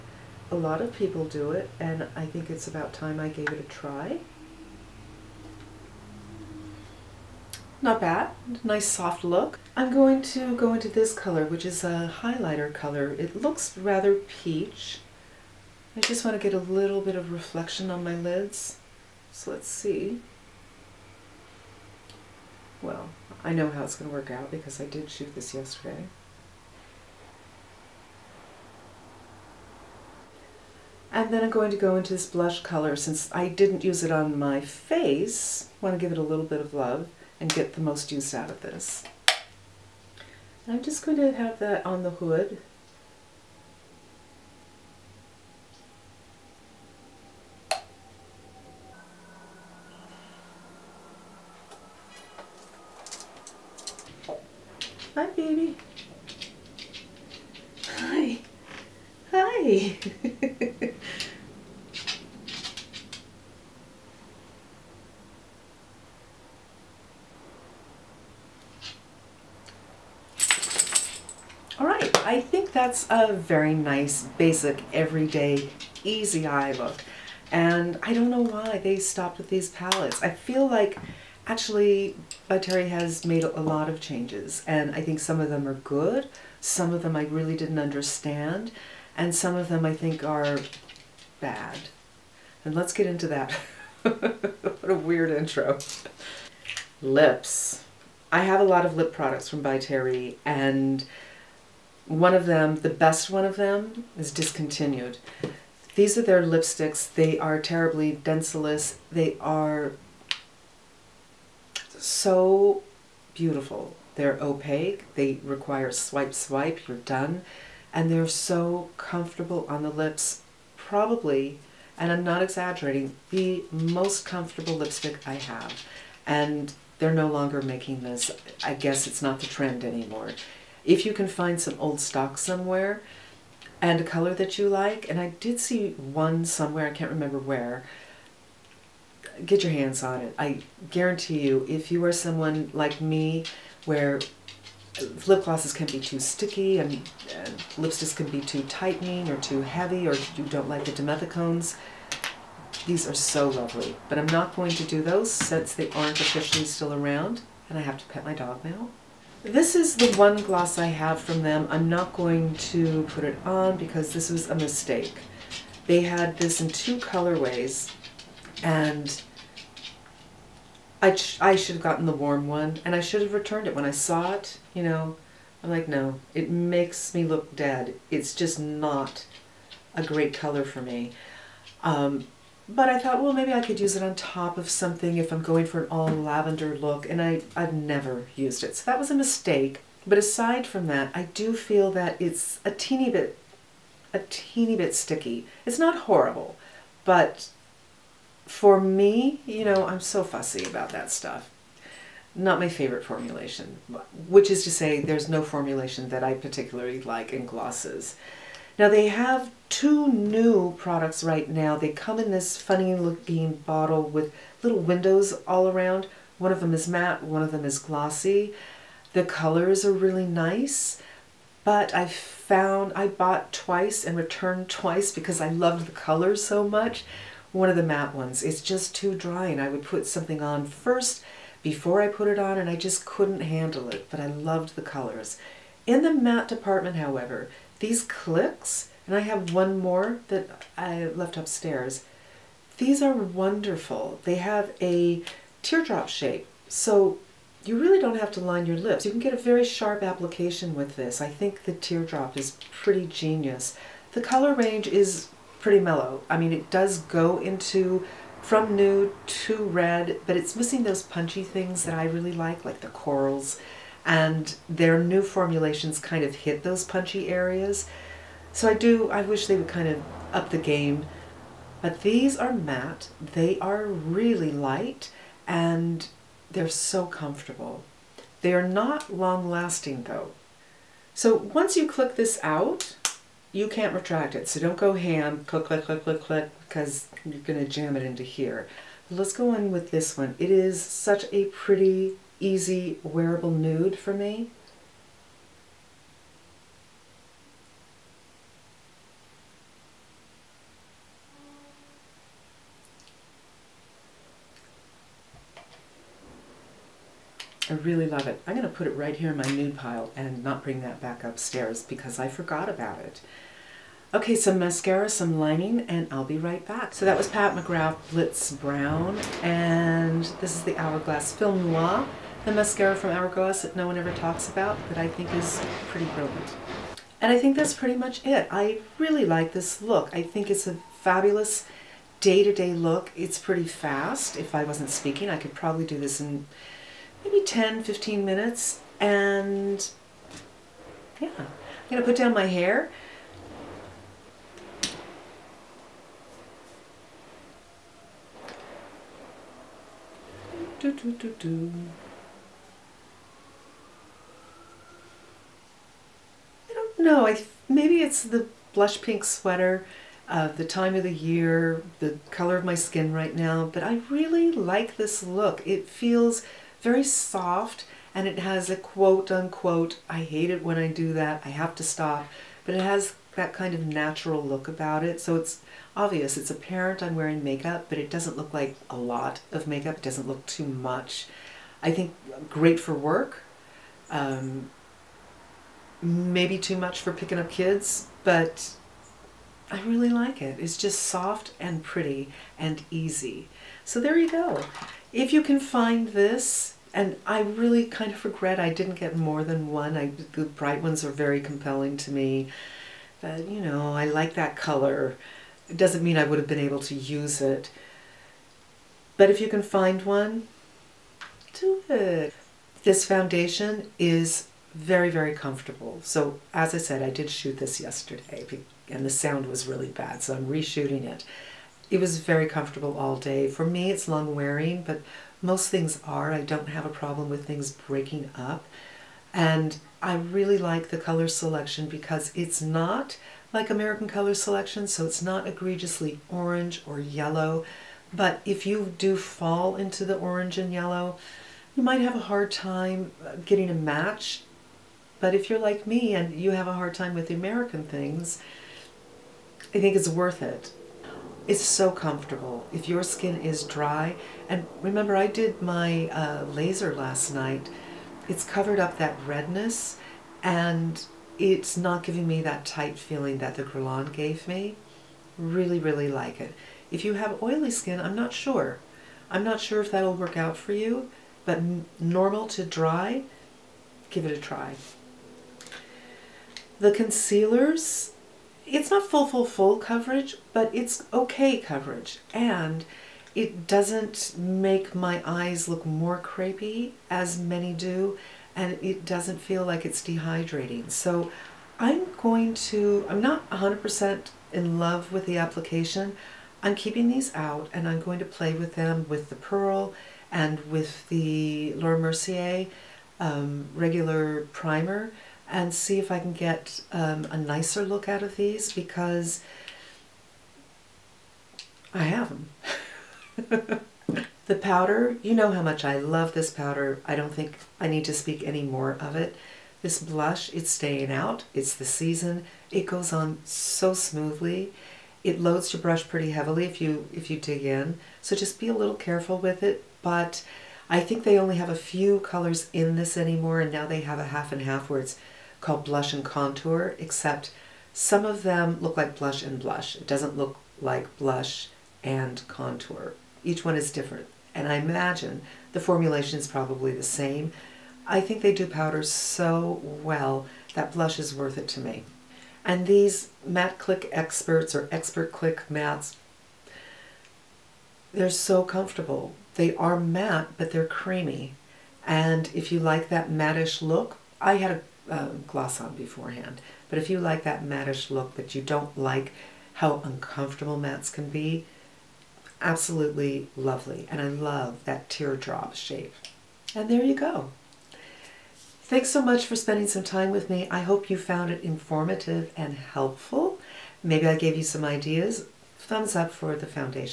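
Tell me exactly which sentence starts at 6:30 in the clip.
It's just soft and pretty and easy.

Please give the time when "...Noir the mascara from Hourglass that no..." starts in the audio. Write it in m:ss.
5:21.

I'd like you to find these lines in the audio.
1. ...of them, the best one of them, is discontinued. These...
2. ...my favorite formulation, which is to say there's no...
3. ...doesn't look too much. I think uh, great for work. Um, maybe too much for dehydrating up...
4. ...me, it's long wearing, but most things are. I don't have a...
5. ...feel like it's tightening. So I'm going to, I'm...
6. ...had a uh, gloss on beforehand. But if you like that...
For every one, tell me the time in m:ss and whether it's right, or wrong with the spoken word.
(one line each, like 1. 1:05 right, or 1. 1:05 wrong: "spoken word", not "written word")
1. 1:42 right
2. 3:22 right
3. 6:20 wrong: "picking", not "dehydrating"
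4. 7:03 right
5. 8:09 wrong: "dehydrating", not "tightening"
6. 9:24 right.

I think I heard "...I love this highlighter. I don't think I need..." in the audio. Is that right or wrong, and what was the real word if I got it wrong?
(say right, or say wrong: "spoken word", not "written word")
wrong: "powder", not "highlighter".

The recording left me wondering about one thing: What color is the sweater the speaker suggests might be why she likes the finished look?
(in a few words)
blush pink.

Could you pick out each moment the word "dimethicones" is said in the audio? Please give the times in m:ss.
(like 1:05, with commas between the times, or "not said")
2:30.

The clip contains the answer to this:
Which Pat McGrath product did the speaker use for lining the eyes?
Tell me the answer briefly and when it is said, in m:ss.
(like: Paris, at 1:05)
Blitz Brown, at 5:18.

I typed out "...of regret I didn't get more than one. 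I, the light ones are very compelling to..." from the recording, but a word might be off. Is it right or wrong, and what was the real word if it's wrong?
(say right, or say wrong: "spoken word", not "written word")
wrong: "bright", not "light".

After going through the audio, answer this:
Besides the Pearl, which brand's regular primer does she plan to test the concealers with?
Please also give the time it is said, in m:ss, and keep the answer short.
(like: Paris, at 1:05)
Laura Mercier, at 8:21.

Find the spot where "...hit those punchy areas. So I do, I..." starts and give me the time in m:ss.
4:26.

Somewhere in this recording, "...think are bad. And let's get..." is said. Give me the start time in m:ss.
1:29.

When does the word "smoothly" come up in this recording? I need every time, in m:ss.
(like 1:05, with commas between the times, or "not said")
8:43.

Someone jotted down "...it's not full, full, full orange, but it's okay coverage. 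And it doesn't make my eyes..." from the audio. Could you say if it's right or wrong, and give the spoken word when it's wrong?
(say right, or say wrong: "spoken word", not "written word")
wrong: "coverage", not "orange".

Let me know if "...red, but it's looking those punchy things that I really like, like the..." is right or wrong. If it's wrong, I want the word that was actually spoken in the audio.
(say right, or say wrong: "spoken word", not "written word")
wrong: "missing", not "looking".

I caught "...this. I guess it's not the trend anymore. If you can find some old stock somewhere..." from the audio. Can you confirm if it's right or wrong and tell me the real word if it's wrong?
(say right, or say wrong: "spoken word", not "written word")
right.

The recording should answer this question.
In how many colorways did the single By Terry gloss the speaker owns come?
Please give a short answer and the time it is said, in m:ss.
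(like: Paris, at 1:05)
2, at 2:46.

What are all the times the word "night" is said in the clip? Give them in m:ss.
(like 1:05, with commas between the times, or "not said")
7:37.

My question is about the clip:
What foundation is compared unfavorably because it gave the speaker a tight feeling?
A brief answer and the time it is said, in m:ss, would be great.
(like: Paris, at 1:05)
Grillon, at 7:43.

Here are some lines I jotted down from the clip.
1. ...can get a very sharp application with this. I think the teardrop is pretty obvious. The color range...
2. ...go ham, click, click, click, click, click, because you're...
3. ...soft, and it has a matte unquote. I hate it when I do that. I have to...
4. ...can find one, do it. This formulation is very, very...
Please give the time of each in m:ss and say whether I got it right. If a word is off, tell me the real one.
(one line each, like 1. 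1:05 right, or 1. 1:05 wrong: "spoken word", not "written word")
1. 4:09 wrong: "genius", not "obvious"
2. 4:44 right
3. 6:07 wrong: "quote", not "matte"
4. 6:49 wrong: "foundation", not "formulation".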